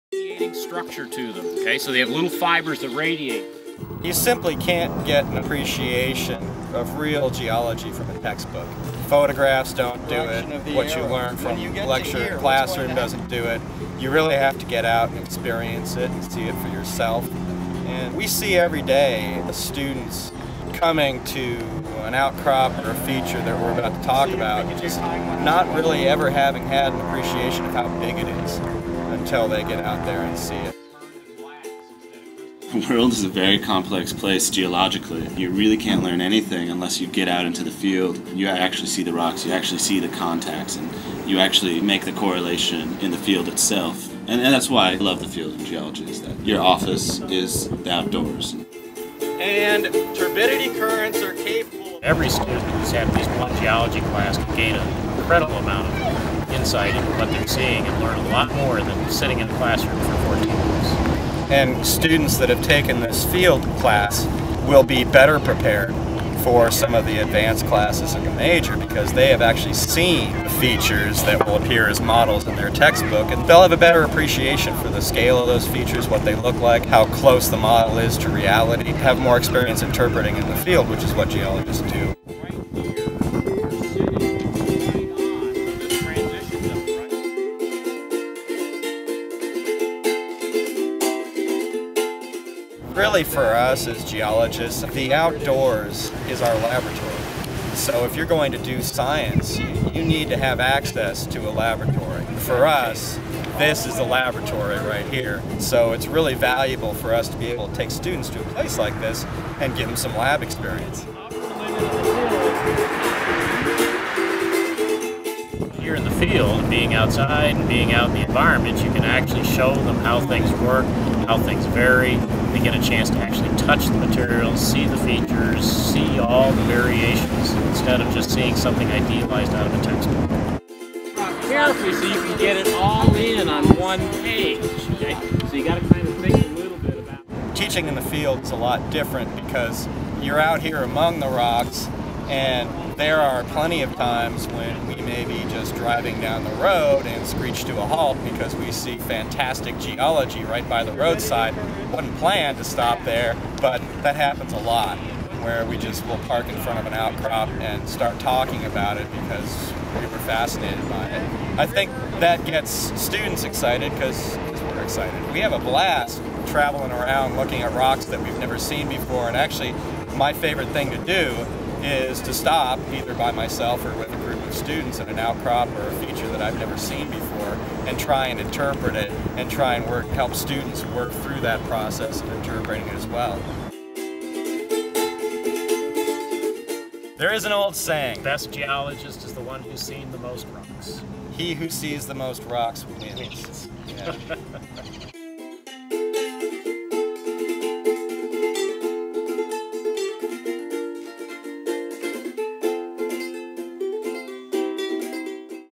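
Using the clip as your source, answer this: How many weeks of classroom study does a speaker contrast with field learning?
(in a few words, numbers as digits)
14.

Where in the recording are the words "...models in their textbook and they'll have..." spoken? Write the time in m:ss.
1:12.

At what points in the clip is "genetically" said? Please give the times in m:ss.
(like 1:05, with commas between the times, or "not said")
not said.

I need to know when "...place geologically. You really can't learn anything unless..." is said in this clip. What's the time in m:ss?
0:34.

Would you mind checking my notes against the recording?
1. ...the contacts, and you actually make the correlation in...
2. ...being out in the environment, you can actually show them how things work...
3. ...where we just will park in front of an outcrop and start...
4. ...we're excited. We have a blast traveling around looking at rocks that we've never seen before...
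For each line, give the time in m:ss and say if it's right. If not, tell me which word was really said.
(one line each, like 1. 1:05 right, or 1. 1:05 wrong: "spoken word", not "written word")
1. 0:39 right
2. 1:57 right
3. 2:35 right
4. 2:44 right.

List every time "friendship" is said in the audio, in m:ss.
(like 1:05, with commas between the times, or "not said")
not said.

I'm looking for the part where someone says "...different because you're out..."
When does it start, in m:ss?
2:18.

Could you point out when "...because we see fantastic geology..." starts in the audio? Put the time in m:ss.
2:28.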